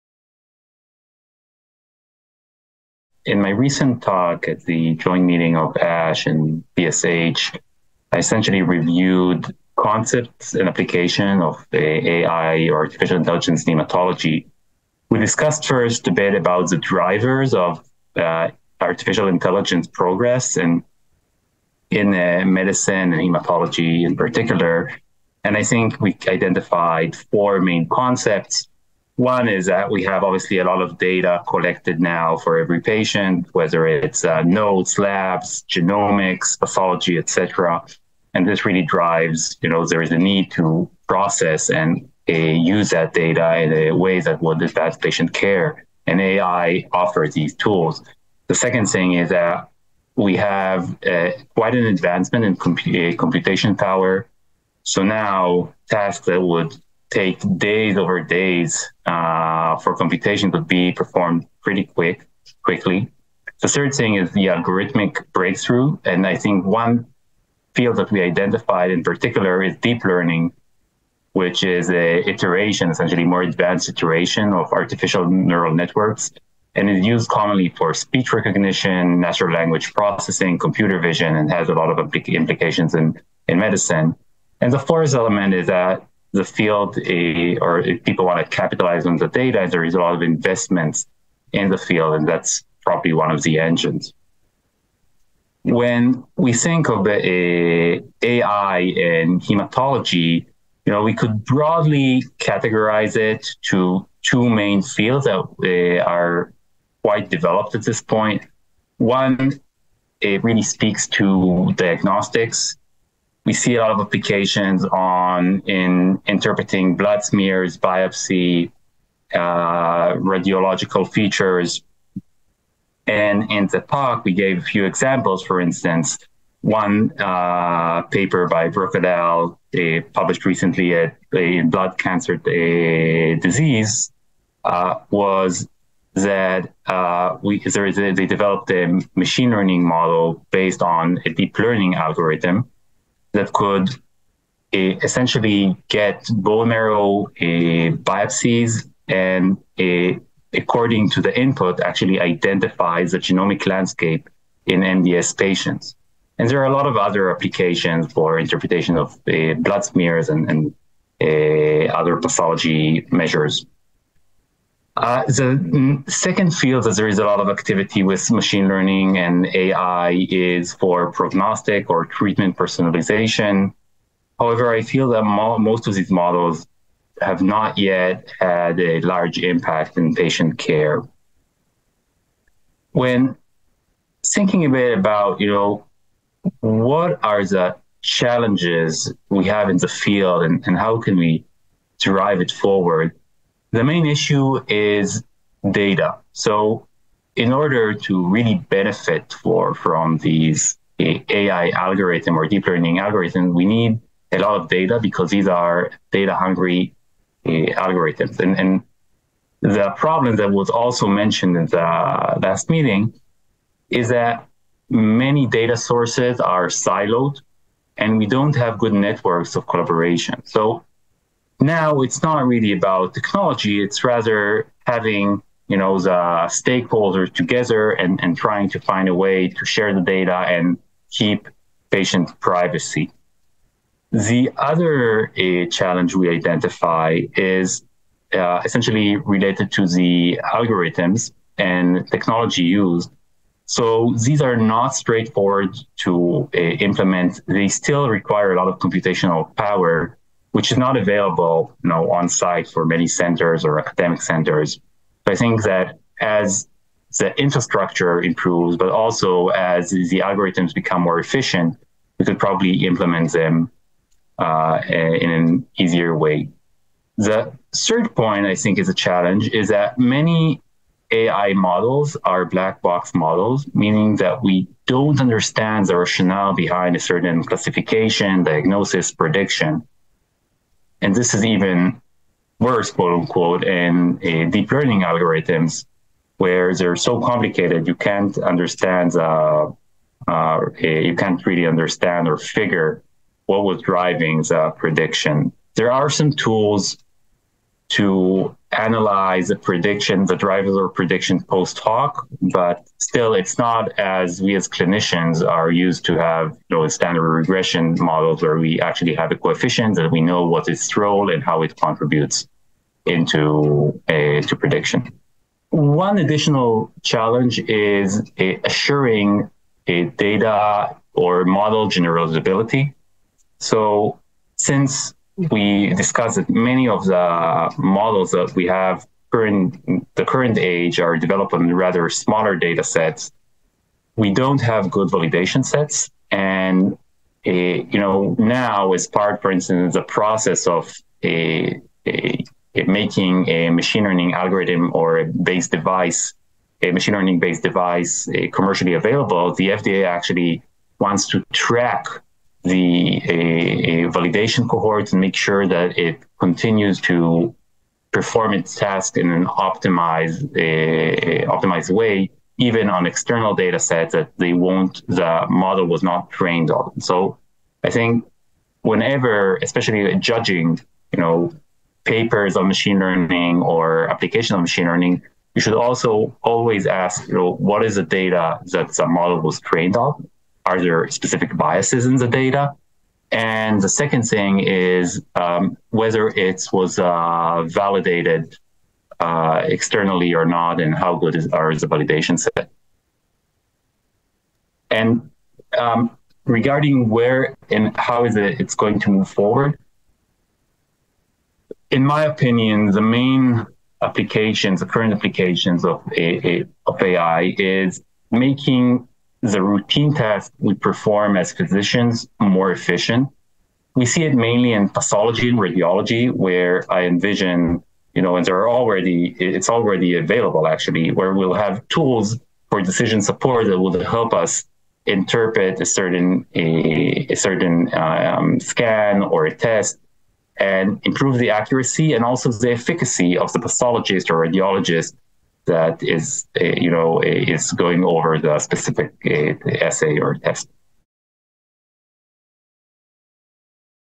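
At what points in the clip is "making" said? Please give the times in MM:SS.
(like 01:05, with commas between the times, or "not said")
05:42, 06:48.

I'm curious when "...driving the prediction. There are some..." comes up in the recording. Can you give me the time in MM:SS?
04:53.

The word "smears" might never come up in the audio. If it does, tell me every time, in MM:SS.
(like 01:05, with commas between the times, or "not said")
01:57, 02:39.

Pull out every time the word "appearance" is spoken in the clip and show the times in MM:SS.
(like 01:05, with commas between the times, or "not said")
not said.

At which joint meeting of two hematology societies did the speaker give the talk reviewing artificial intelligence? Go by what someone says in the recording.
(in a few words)
ASH and BSH.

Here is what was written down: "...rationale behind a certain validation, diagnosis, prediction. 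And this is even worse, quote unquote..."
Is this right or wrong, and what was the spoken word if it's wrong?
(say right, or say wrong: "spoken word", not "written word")
wrong: "classification", not "validation".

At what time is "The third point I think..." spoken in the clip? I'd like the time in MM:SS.
04:27.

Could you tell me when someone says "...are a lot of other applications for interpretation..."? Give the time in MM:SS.
02:36.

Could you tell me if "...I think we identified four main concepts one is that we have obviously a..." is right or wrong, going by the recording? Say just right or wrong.
right.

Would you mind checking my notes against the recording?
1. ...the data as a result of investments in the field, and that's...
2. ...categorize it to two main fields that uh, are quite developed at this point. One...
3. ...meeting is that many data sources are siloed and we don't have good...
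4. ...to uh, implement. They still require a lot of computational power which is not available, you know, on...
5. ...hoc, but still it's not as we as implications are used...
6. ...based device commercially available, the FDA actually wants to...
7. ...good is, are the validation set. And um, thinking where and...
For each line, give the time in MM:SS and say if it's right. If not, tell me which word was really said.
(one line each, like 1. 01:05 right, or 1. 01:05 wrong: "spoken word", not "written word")
1. 01:29 right
2. 01:42 right
3. 03:32 right
4. 04:06 right
5. 05:01 wrong: "clinicians", not "implications"
6. 05:47 right
7. 06:31 wrong: "regarding", not "thinking".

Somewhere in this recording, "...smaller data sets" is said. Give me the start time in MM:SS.
05:32.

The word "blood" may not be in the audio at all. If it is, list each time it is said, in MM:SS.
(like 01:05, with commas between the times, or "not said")
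01:56, 02:11, 02:39.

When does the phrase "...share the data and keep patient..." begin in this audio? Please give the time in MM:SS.
03:49.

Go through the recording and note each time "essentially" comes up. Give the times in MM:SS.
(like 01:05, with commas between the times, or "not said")
00:08, 01:12, 02:25, 03:58.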